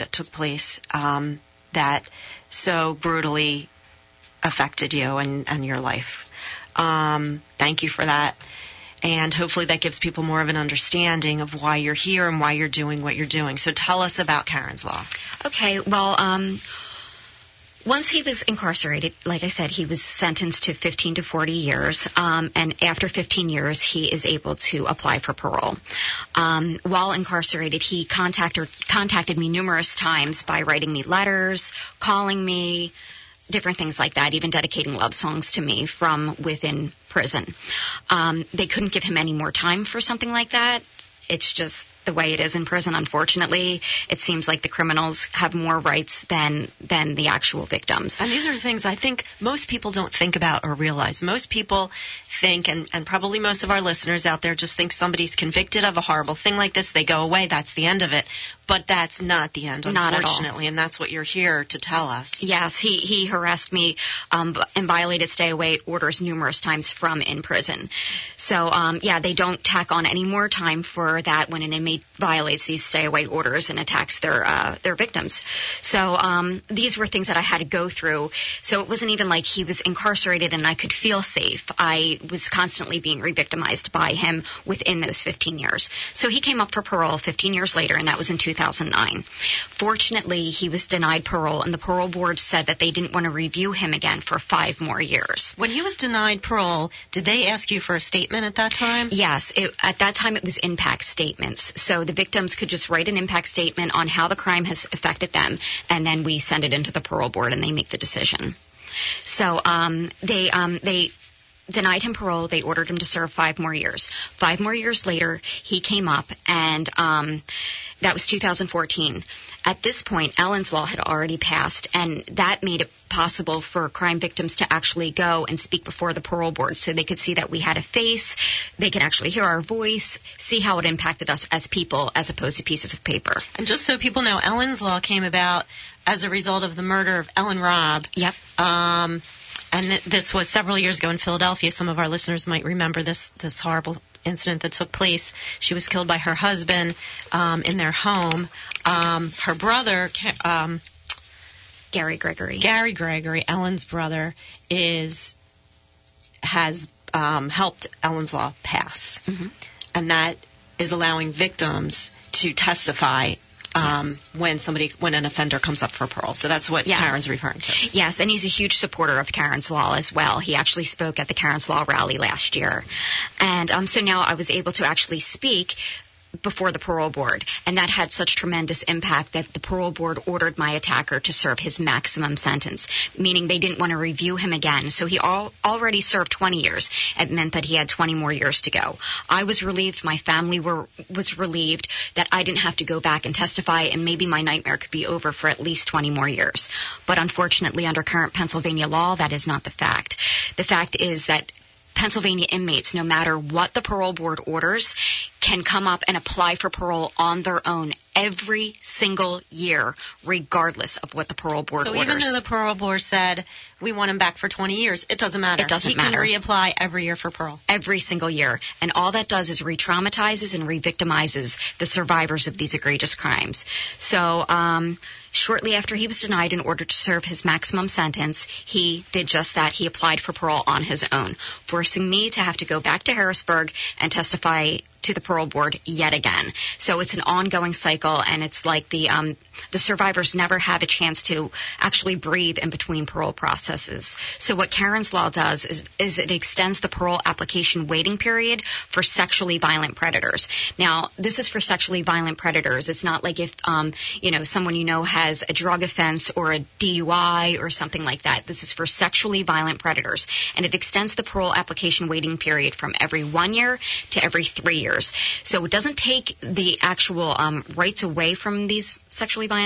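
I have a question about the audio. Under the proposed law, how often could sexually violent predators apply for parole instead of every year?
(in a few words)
every 3 years.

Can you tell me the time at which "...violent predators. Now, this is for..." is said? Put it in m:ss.
4:09.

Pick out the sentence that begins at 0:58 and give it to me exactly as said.
But that's not the end, not unfortunately, and that's what you're here to tell us.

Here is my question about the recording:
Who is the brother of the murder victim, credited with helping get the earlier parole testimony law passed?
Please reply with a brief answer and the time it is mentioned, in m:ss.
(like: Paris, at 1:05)
Gary Gregory, at 2:32.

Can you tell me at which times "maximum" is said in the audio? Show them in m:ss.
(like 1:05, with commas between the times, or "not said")
3:01, 3:47.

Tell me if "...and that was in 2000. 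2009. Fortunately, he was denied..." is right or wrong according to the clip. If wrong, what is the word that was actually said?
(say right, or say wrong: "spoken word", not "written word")
right.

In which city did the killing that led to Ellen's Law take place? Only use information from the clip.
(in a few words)
Philadelphia.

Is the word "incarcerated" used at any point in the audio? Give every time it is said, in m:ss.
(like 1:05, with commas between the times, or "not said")
0:18, 0:27, 1:19.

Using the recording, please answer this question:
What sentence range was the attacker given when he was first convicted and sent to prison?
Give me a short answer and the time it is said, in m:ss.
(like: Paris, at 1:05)
15 to 40 years, at 0:20.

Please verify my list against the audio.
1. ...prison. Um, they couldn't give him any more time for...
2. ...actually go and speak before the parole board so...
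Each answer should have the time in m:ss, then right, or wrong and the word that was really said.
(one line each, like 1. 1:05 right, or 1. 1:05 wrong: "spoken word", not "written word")
1. 0:37 right
2. 2:04 right.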